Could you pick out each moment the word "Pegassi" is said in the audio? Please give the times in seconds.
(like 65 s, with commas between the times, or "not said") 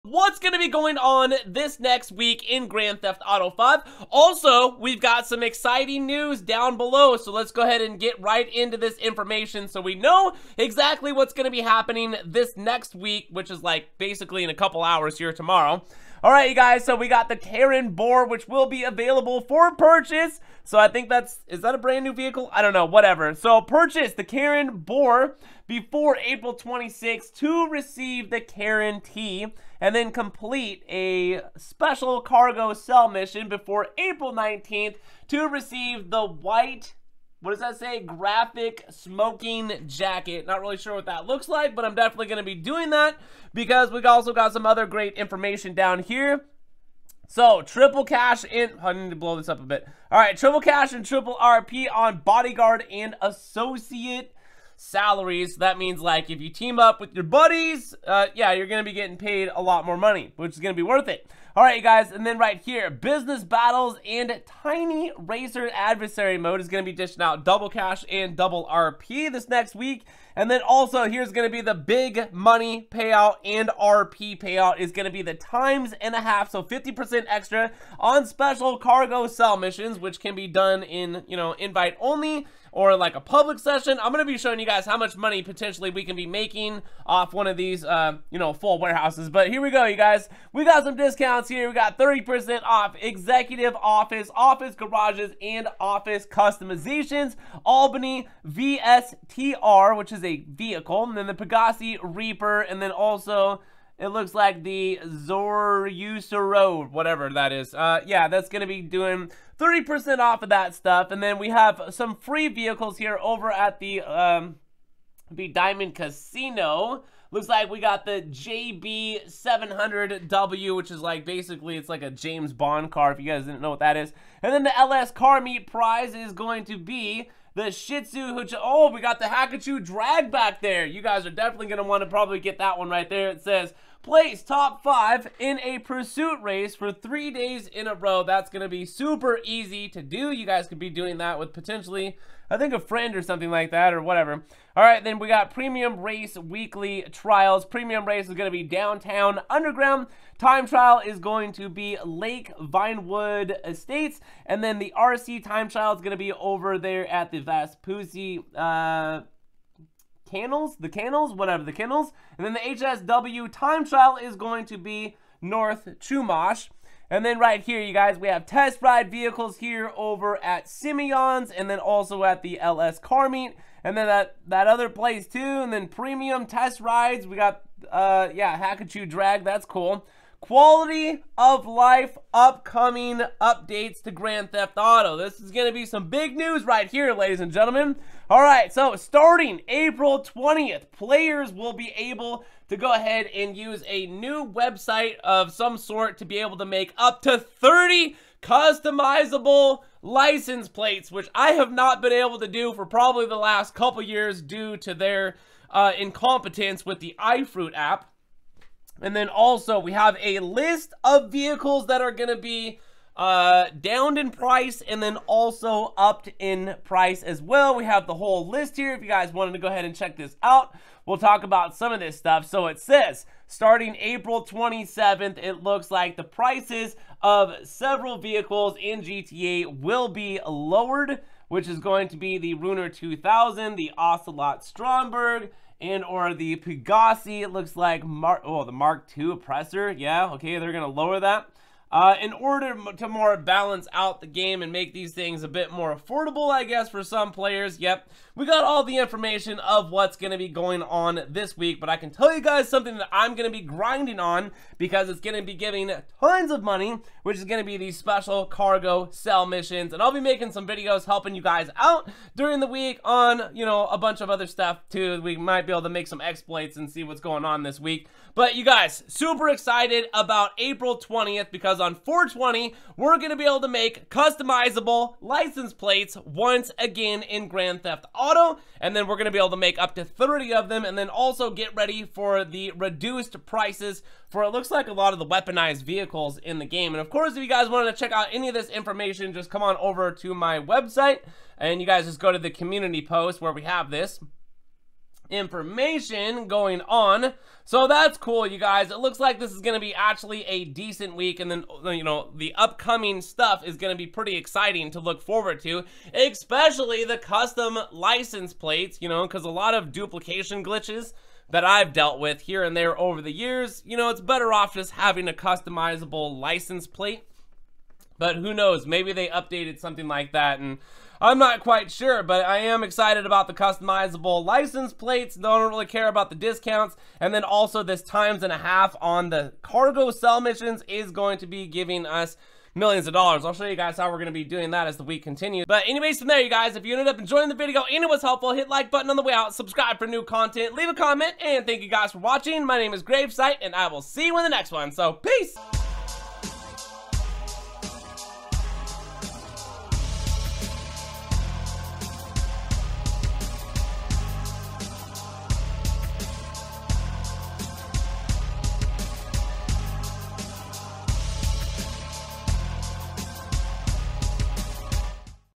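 101 s, 236 s.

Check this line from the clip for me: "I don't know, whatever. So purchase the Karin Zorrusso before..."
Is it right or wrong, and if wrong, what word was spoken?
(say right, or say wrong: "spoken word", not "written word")
wrong: "Boor", not "Zorrusso".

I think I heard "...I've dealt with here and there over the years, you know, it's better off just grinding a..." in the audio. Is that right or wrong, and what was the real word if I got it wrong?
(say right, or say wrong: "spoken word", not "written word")
wrong: "having", not "grinding".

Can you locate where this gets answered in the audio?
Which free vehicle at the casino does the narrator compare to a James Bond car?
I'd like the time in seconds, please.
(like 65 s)
118 s.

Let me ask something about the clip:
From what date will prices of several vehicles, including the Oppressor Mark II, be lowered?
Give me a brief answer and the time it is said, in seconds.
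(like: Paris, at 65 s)
April 27th, at 223 s.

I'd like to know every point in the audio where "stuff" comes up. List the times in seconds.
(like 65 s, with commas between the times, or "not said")
110 s, 222 s, 264 s, 303 s.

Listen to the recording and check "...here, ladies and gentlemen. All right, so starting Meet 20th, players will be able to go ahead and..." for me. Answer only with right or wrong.
wrong.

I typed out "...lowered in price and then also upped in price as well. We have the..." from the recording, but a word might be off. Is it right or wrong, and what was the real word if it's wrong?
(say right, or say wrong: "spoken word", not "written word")
wrong: "downed", not "lowered".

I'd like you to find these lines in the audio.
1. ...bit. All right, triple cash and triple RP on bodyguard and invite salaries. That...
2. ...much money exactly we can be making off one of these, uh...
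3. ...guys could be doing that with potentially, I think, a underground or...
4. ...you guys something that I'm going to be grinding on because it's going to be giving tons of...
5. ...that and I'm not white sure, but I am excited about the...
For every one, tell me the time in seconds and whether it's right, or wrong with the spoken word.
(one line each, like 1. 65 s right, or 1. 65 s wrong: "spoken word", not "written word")
1. 49 s wrong: "associate", not "invite"
2. 84 s wrong: "potentially", not "exactly"
3. 140 s wrong: "friend", not "underground"
4. 252 s right
5. 320 s wrong: "quite", not "white".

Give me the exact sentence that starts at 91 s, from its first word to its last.
We got 30% off executive office, office garages, and office customizations.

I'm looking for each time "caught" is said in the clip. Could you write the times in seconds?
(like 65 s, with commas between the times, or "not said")
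not said.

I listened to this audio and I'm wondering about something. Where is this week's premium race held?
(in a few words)
Downtown Underground.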